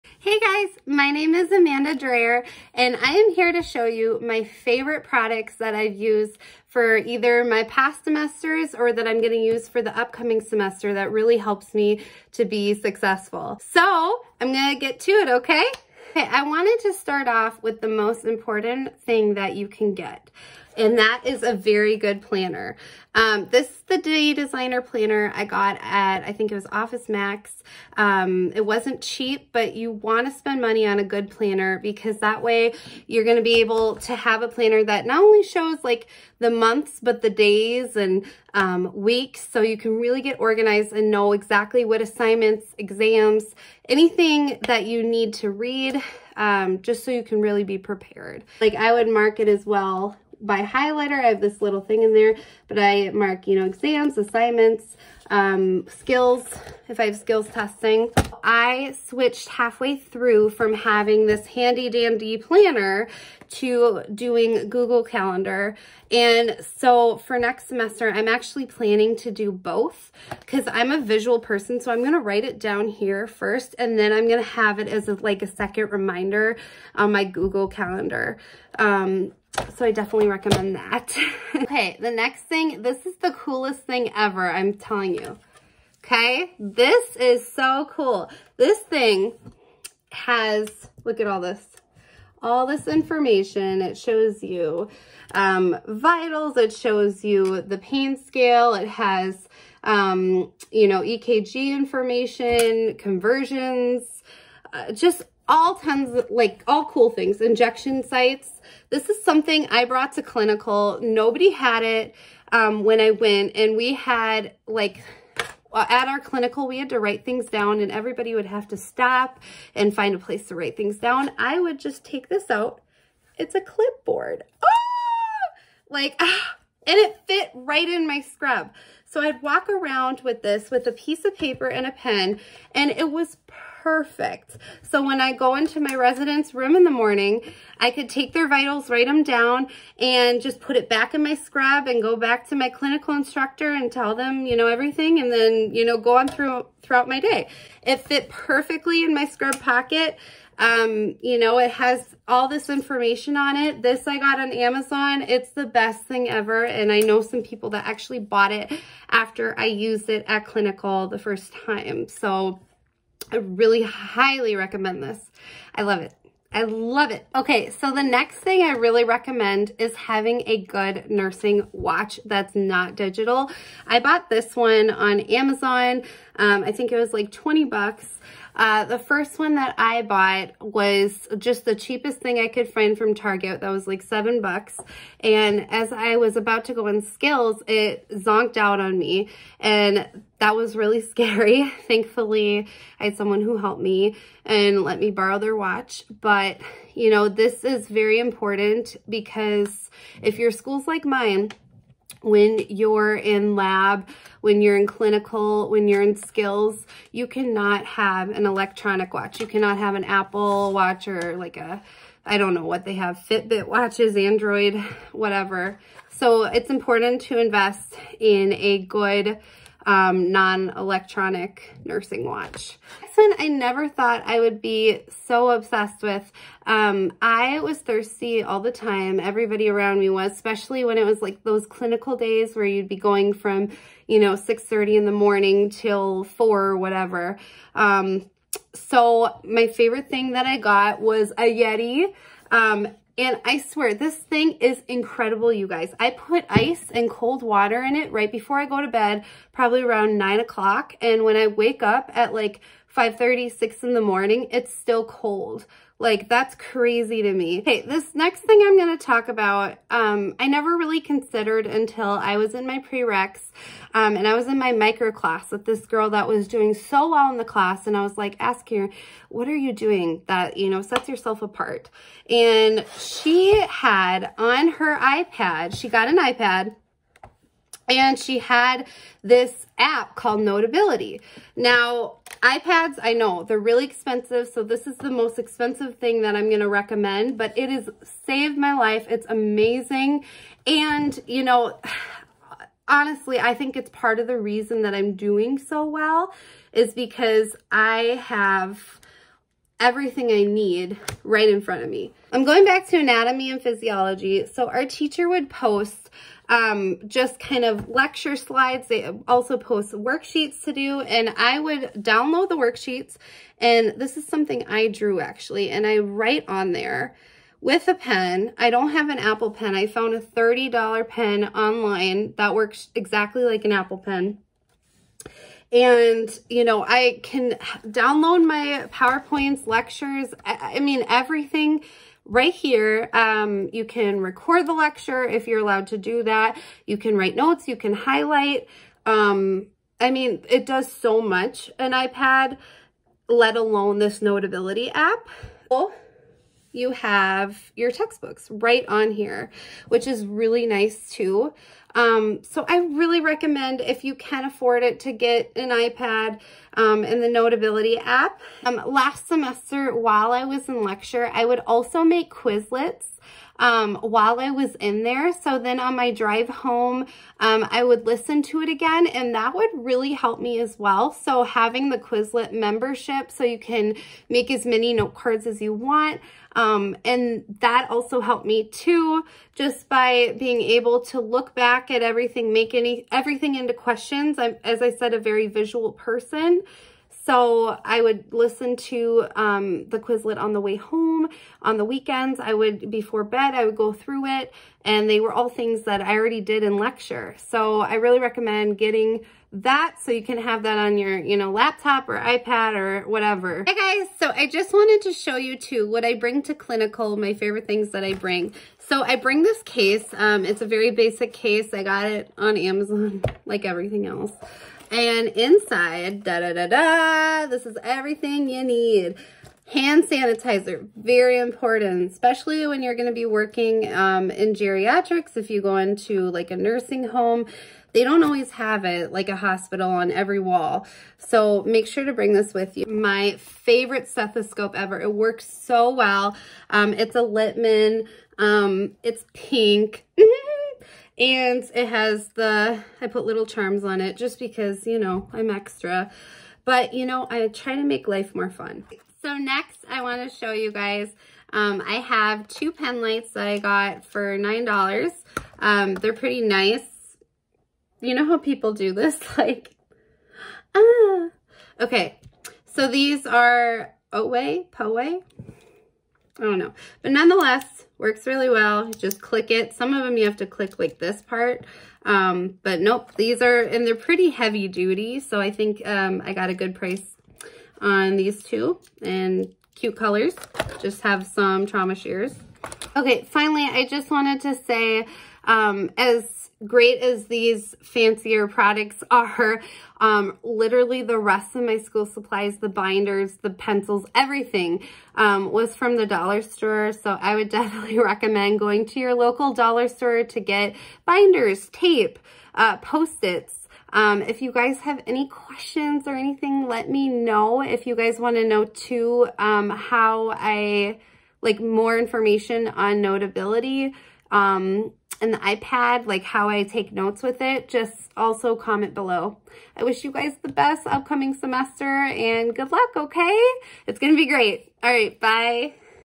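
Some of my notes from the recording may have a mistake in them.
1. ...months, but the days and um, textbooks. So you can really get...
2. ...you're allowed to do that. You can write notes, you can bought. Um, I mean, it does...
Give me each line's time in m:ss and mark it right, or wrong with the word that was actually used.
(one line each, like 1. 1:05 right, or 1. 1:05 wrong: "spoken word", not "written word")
1. 0:36 wrong: "weeks", not "textbooks"
2. 5:35 wrong: "highlight", not "bought".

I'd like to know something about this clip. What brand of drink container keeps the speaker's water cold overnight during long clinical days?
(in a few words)
Yeti.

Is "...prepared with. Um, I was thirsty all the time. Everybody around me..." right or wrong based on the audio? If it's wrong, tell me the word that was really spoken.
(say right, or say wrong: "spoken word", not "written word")
wrong: "obsessed", not "prepared".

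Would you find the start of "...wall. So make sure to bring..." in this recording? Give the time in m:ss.
7:10.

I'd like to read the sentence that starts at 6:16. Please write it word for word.
Um, and that also helped me too, just by being able to look back at everything, make any everything into questions.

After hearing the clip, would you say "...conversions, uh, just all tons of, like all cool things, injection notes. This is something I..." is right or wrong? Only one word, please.
wrong.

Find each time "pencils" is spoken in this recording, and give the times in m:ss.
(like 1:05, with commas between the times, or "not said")
8:13.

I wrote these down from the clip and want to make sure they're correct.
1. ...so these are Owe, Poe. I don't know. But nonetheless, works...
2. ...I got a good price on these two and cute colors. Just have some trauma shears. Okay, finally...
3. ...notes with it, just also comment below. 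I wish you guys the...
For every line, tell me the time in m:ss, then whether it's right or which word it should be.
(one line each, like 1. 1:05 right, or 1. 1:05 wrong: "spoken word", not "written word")
1. 7:42 right
2. 7:56 right
3. 8:36 right.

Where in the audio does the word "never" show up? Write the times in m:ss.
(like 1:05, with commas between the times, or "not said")
3:43, 4:20.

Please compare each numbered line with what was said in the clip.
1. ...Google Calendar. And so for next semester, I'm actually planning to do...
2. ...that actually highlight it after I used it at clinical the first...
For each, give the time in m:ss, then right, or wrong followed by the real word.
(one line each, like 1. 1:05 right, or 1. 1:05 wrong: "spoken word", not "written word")
1. 1:04 right
2. 2:37 wrong: "bought", not "highlight".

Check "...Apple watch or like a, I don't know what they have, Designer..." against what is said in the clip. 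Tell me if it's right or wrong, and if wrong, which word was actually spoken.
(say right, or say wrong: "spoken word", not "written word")
wrong: "Fitbit", not "Designer".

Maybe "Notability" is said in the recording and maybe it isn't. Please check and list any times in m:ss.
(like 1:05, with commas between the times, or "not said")
4:40, 5:44, 5:57, 8:33.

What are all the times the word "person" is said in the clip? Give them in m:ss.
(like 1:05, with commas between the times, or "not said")
1:11, 6:25.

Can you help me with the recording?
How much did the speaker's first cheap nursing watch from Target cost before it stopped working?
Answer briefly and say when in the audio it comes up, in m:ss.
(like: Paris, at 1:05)
$7, at 3:04.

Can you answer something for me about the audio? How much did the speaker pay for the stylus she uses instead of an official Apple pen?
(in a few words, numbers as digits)
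$30.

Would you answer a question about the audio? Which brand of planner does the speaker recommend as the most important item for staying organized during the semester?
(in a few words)
Day Designer.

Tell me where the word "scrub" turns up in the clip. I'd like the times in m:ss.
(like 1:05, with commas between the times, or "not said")
2:08, 2:21, 2:29.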